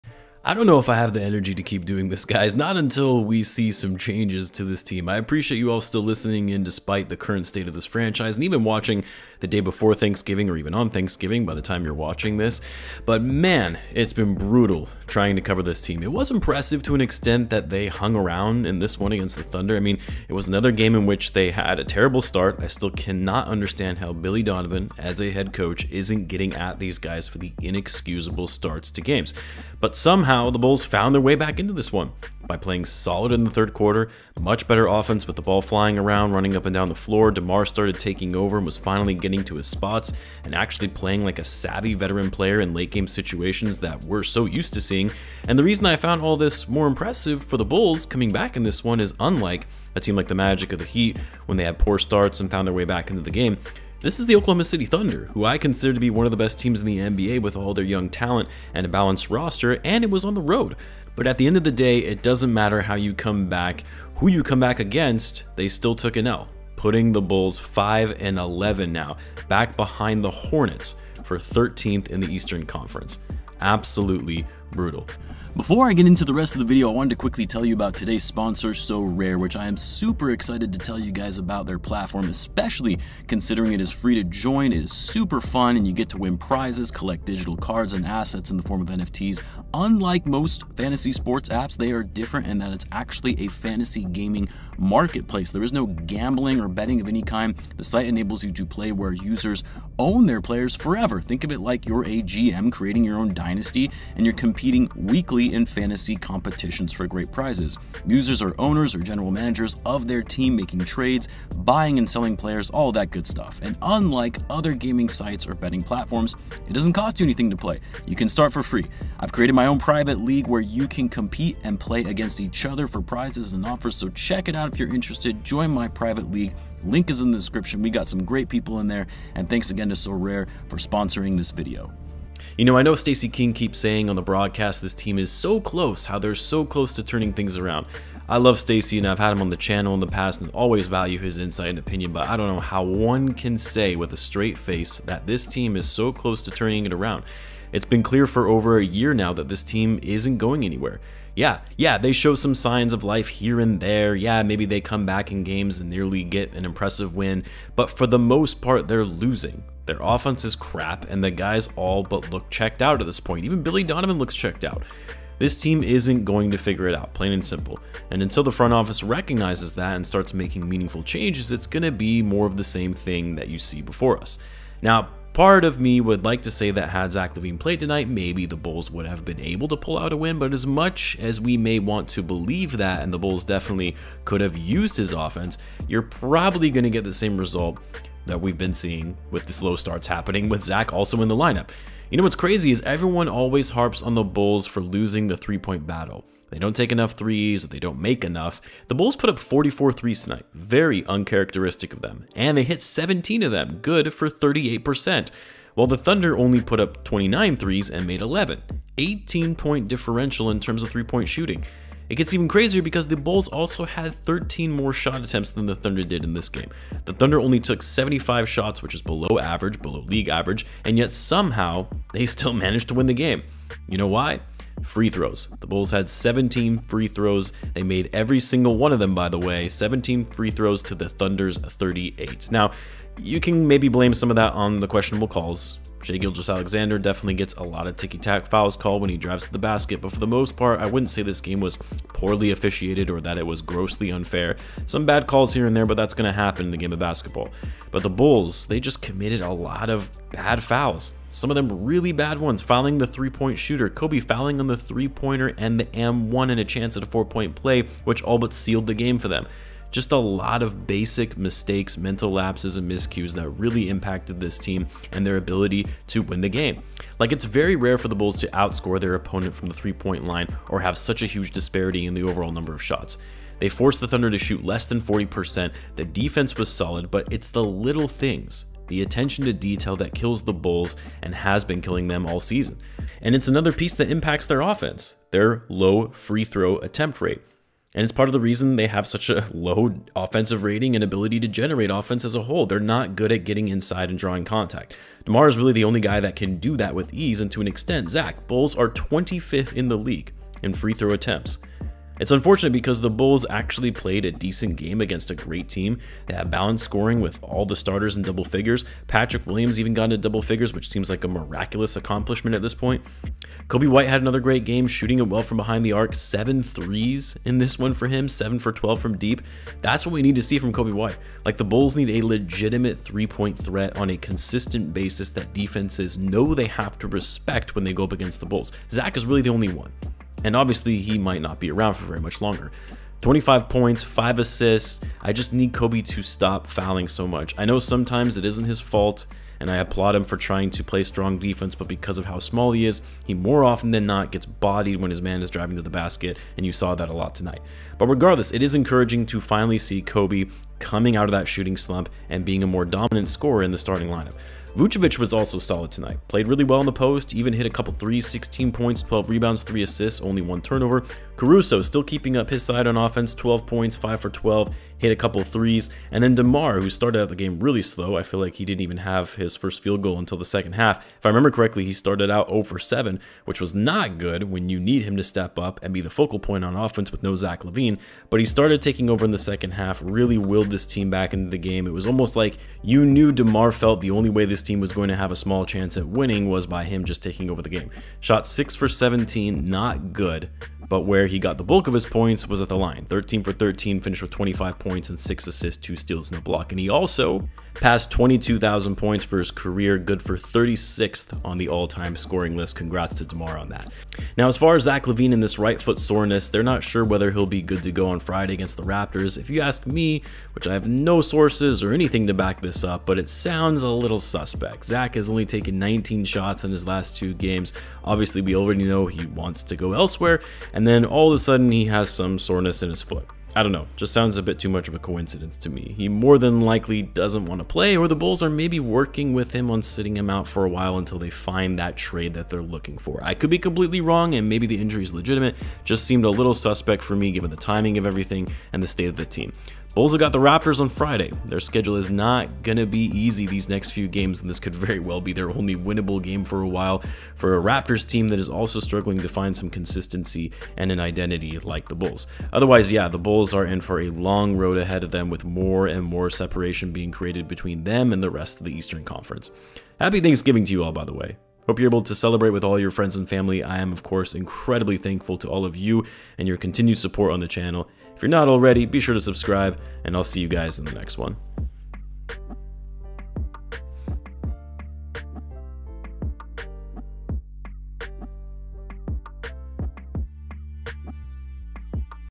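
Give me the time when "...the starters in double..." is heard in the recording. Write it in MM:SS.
05:07.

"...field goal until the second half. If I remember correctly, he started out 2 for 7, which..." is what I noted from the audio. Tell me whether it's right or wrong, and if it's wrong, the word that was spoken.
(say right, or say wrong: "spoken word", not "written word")
wrong: "0", not "2".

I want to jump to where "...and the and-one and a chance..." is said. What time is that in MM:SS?
04:15.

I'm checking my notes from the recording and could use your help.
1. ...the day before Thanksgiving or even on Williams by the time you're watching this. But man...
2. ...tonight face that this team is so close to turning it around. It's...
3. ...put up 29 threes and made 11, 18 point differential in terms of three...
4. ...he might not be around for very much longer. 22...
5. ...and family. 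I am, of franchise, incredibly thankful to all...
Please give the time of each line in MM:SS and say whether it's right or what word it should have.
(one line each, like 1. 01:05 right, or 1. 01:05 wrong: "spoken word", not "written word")
1. 00:09 wrong: "Thanksgiving", not "Williams"
2. 02:24 wrong: "straight", not "tonight"
3. 03:26 right
4. 05:30 wrong: "25", not "22"
5. 07:43 wrong: "course", not "franchise".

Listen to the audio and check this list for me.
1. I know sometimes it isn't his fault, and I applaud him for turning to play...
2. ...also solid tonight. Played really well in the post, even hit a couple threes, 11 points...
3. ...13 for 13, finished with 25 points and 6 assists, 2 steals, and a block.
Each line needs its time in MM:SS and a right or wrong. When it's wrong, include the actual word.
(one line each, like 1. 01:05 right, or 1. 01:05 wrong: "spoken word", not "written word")
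1. 05:37 wrong: "trying", not "turning"
2. 05:55 wrong: "16", not "11"
3. 06:33 right.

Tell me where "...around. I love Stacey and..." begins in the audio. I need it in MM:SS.
02:17.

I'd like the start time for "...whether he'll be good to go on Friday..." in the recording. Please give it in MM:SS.
06:47.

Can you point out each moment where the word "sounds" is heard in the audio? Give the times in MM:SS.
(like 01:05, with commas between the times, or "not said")
06:53, 07:04.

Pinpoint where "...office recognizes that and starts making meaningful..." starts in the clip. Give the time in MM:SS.
02:48.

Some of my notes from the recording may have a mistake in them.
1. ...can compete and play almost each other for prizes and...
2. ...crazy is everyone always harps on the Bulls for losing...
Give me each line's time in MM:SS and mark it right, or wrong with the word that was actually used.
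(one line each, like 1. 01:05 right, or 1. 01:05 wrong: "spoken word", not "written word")
1. 02:00 wrong: "against", not "almost"
2. 03:12 right.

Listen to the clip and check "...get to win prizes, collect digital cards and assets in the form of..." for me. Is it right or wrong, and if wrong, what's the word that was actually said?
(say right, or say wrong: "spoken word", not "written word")
right.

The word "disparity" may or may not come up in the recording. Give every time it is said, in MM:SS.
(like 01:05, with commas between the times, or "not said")
04:31.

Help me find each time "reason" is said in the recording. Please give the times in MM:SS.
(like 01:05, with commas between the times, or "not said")
00:45, 04:48.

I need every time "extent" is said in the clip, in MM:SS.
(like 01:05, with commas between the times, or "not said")
00:17, 04:57.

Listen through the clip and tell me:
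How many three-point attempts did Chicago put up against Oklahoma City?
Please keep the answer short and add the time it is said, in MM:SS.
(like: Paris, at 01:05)
44, at 03:19.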